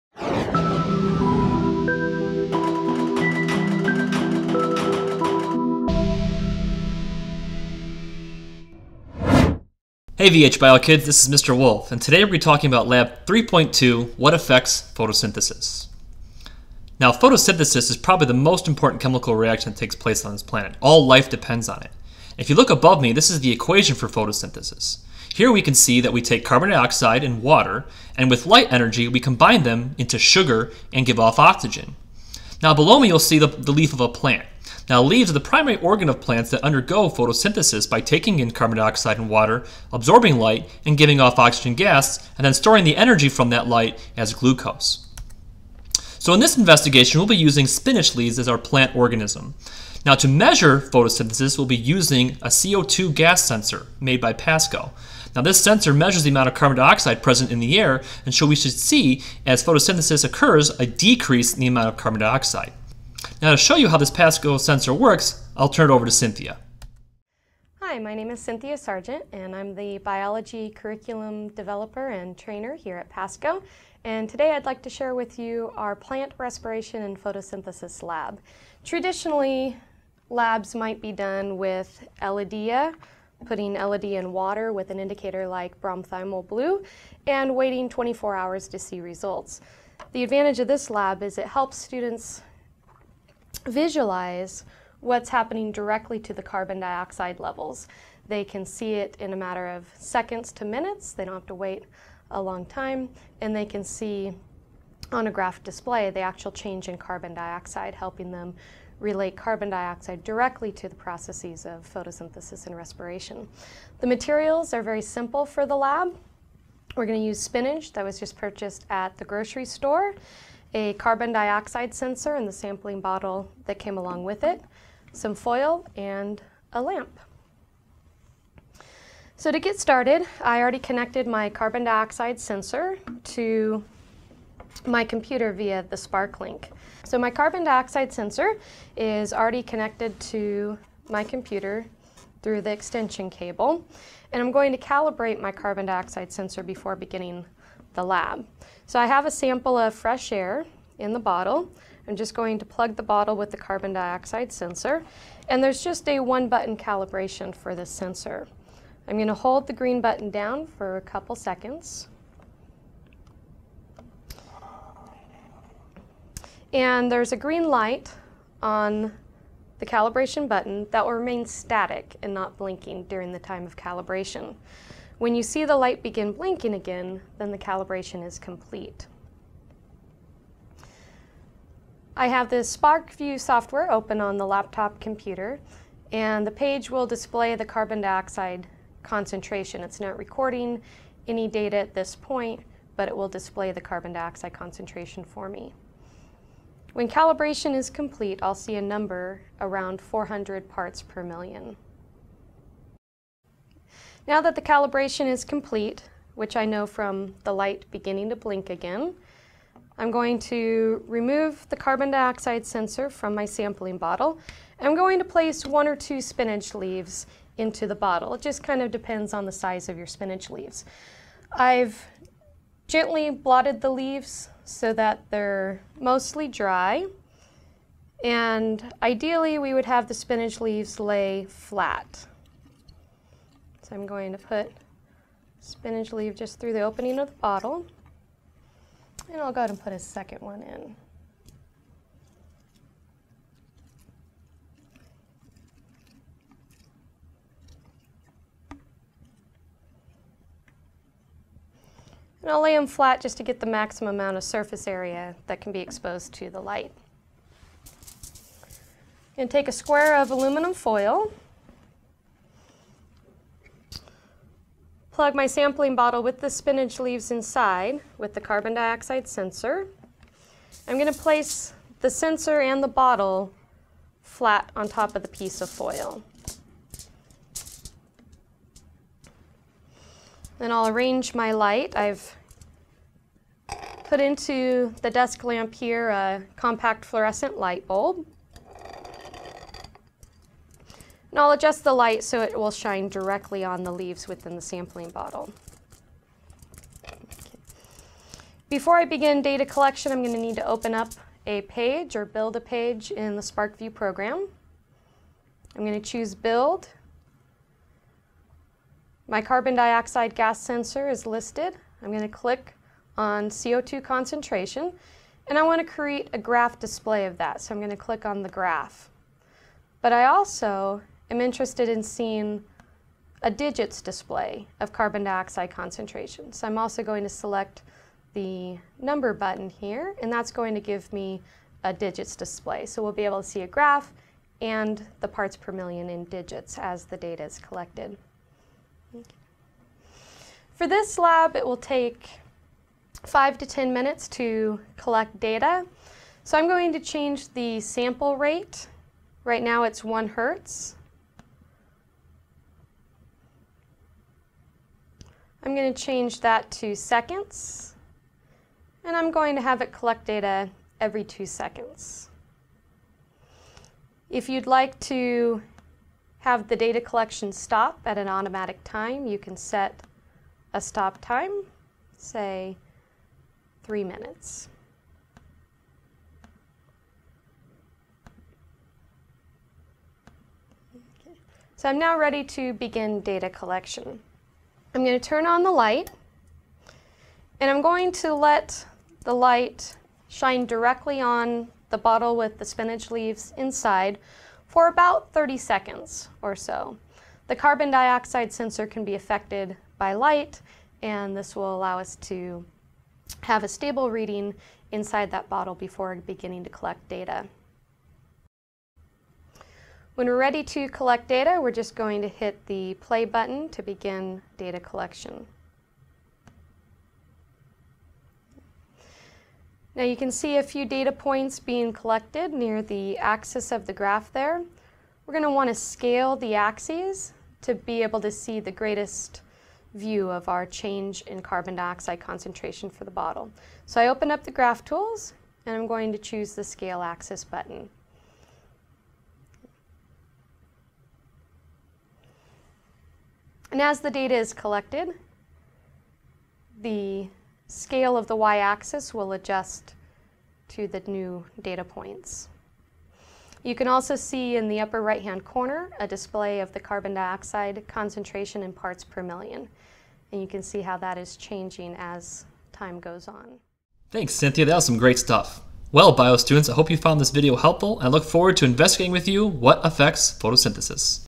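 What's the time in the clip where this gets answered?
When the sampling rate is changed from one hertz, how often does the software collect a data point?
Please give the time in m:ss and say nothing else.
6:00.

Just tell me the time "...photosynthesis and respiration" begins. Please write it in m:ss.
1:51.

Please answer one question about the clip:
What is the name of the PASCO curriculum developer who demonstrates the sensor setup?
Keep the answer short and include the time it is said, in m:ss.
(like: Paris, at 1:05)
Cynthia Sargent, at 1:08.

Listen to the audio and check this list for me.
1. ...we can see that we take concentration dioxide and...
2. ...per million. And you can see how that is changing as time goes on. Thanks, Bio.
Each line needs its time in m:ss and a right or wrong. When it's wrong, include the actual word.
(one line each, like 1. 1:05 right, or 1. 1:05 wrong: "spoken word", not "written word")
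1. 0:25 wrong: "carbon", not "concentration"
2. 7:39 wrong: "Cynthia", not "Bio".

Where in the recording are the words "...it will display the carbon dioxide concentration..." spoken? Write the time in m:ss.
3:13.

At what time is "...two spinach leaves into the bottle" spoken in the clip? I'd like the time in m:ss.
3:35.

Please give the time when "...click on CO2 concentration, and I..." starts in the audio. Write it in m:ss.
5:12.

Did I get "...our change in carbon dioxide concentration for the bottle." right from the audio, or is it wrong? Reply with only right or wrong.
right.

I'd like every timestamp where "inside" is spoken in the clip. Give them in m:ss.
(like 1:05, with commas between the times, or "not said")
4:27, 6:33, 6:44.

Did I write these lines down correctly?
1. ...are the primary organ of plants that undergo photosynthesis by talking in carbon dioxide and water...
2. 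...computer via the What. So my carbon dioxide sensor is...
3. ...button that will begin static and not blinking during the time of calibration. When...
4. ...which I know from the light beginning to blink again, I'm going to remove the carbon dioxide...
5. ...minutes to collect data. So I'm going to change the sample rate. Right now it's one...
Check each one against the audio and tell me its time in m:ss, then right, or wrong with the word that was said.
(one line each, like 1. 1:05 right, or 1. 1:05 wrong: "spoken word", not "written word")
1. 0:35 wrong: "taking", not "talking"
2. 2:15 wrong: "SparkLink", not "What"
3. 2:50 wrong: "remain", not "begin"
4. 3:26 right
5. 5:43 right.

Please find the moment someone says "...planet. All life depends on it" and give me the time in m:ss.
0:20.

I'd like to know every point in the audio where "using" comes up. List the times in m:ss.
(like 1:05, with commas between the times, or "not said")
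0:47, 0:51.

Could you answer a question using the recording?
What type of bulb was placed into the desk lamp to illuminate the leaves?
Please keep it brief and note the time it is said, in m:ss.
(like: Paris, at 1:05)
Compact fluorescent, at 4:46.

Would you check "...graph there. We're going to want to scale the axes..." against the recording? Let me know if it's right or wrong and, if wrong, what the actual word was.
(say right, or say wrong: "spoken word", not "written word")
right.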